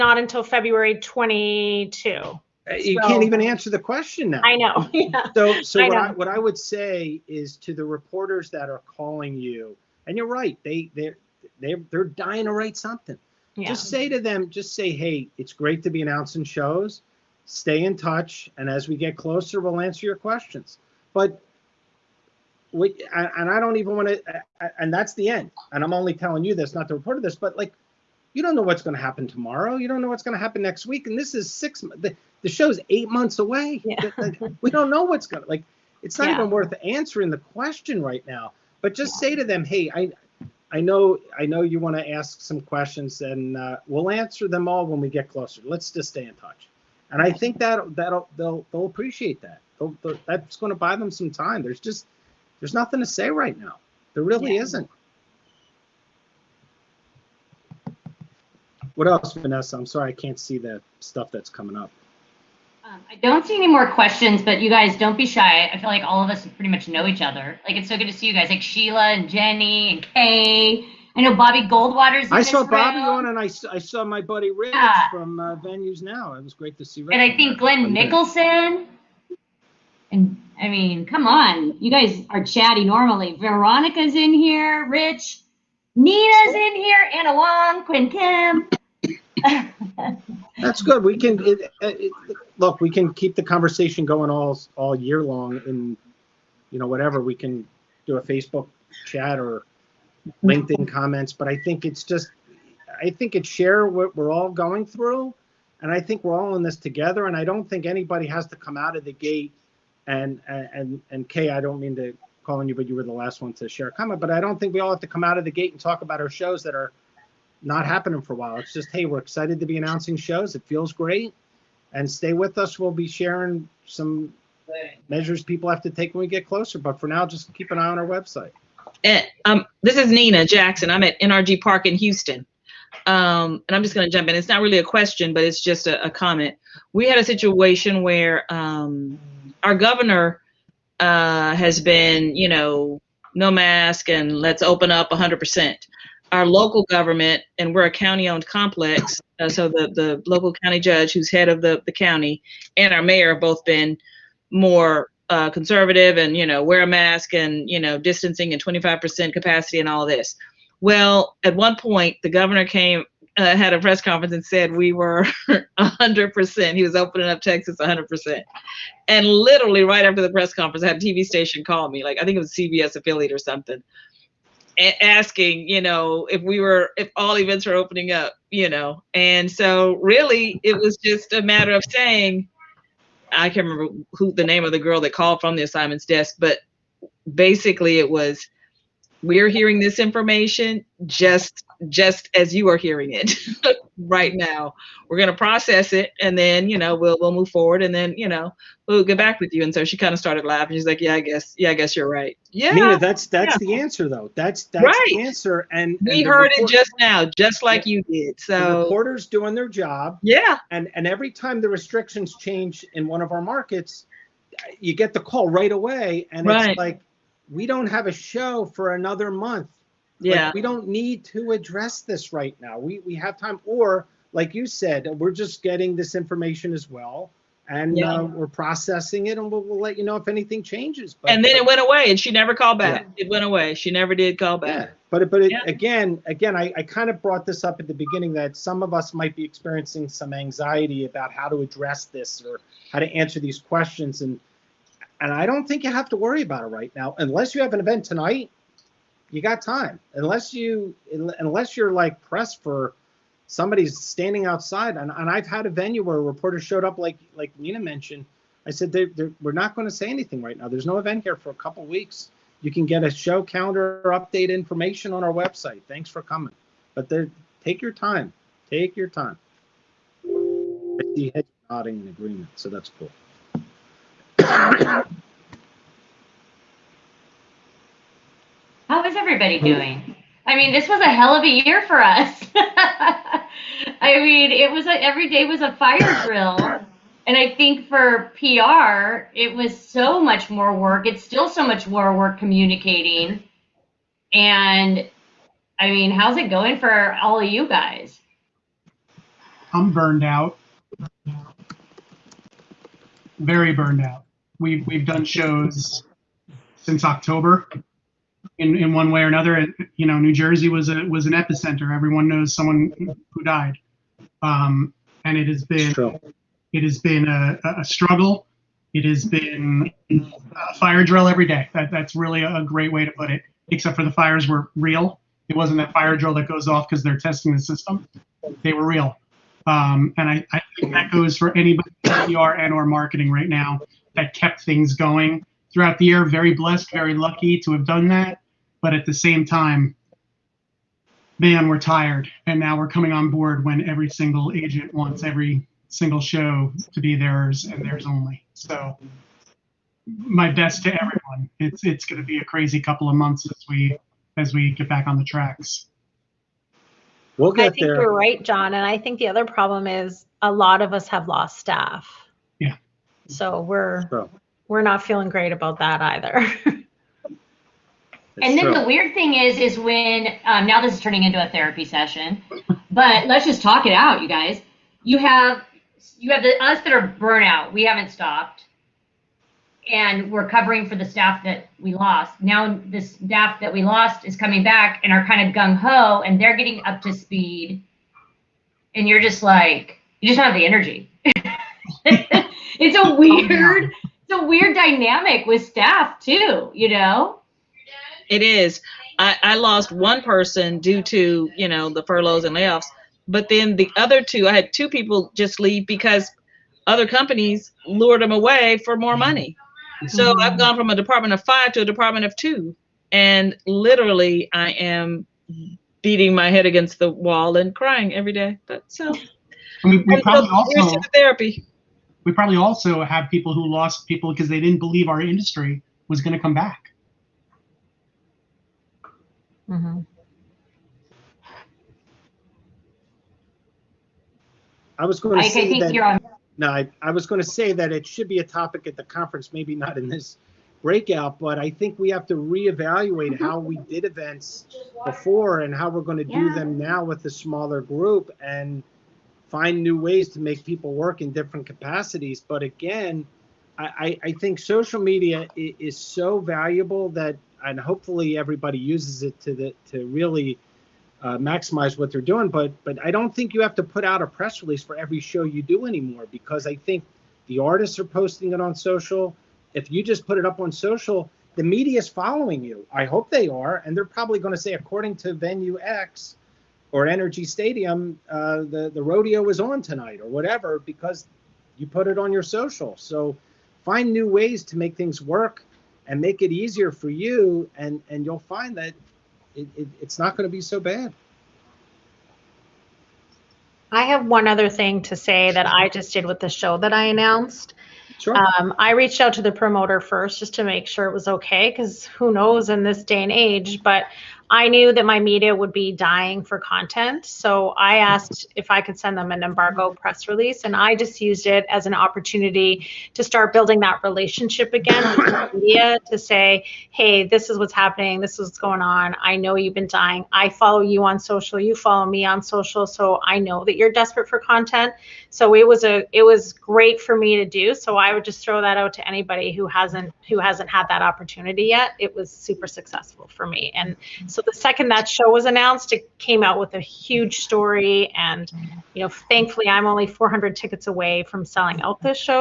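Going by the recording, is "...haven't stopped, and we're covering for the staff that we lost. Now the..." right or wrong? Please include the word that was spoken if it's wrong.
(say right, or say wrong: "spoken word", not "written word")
right.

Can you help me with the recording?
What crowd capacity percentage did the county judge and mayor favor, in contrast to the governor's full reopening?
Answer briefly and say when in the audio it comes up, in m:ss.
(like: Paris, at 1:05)
25%, at 2:38.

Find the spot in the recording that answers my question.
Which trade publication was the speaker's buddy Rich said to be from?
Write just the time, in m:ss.
1:15.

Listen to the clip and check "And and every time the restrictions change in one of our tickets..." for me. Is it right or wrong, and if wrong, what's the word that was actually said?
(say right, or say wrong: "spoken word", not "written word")
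wrong: "markets", not "tickets".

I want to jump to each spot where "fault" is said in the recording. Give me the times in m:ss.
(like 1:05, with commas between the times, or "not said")
not said.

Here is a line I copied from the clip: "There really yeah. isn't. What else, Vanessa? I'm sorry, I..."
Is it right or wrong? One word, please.
right.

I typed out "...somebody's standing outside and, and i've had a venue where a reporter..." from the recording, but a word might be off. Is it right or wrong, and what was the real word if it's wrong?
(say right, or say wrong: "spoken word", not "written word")
right.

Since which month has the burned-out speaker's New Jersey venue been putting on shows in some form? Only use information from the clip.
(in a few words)
October.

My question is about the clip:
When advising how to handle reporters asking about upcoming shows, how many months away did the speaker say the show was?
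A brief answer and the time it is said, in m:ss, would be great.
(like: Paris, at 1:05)
8, at 0:32.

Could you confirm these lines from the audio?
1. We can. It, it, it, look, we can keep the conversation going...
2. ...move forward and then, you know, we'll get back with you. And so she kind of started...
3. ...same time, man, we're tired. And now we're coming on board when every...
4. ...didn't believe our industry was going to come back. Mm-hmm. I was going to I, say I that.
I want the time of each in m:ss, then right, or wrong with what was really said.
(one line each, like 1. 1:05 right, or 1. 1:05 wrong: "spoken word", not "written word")
1. 1:31 right
2. 3:17 right
3. 5:39 right
4. 7:04 right.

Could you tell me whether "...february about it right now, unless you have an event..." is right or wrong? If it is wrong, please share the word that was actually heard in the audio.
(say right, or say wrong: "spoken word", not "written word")
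wrong: "worry", not "february".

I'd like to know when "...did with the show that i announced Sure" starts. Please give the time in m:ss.
8:16.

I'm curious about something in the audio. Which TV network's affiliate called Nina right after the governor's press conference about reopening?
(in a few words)
CBS.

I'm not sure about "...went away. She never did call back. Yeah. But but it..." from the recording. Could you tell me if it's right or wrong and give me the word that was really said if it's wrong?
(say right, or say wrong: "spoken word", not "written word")
right.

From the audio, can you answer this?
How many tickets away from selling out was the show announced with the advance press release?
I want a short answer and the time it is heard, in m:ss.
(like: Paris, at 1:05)
400, at 9:00.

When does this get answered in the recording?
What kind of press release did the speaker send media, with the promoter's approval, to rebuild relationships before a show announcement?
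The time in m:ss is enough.
8:29.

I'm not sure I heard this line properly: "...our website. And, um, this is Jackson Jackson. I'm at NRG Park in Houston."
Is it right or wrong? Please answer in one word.
wrong.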